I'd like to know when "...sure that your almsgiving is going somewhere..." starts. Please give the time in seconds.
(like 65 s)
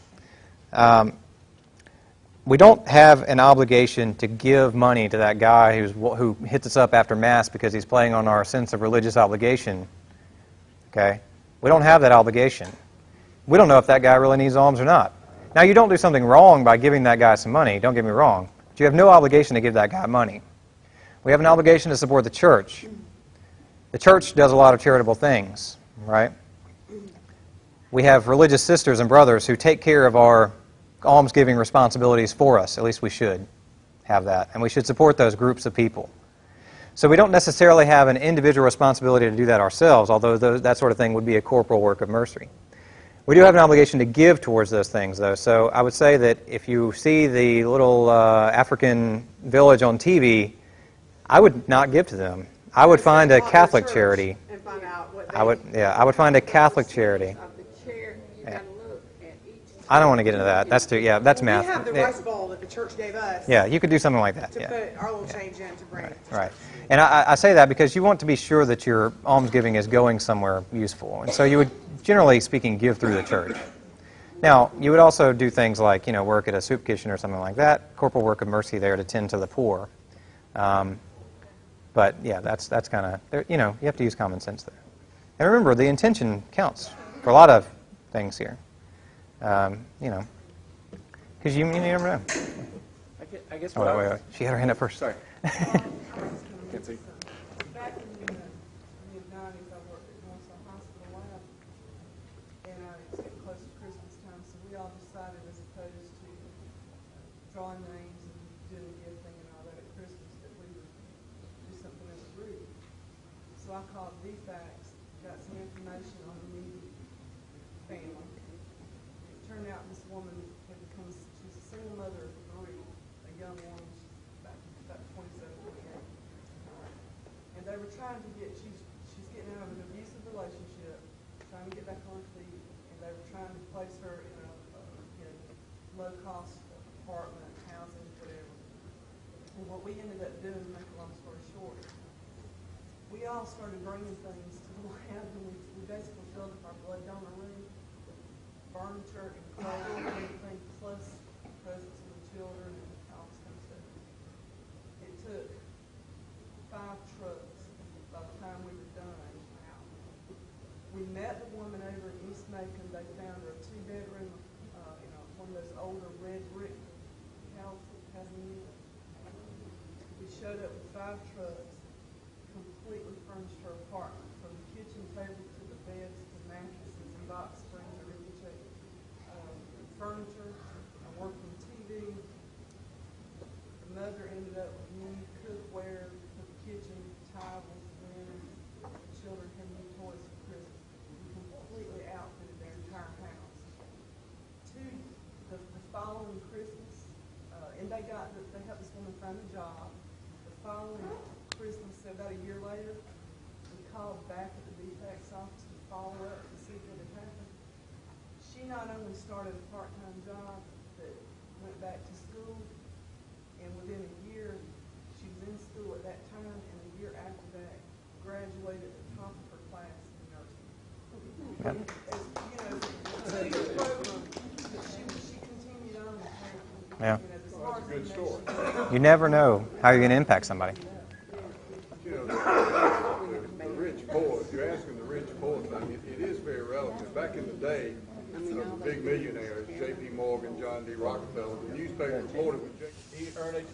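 68 s.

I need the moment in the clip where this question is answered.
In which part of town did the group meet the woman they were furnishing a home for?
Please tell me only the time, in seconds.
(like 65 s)
162 s.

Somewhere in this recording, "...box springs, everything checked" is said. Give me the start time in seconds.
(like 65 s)
177 s.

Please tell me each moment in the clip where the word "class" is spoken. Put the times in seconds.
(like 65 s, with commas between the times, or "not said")
219 s.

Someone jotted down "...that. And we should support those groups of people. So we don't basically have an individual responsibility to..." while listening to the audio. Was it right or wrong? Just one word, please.
wrong.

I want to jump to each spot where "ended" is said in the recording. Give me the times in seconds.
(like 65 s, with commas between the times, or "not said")
139 s, 184 s.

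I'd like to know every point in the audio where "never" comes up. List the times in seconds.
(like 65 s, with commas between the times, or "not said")
91 s, 228 s.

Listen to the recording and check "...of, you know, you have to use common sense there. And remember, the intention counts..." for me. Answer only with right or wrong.
right.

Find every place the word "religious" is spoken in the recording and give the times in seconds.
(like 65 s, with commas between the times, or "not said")
8 s, 28 s.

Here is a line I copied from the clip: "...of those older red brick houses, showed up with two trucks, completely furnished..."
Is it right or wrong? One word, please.
wrong.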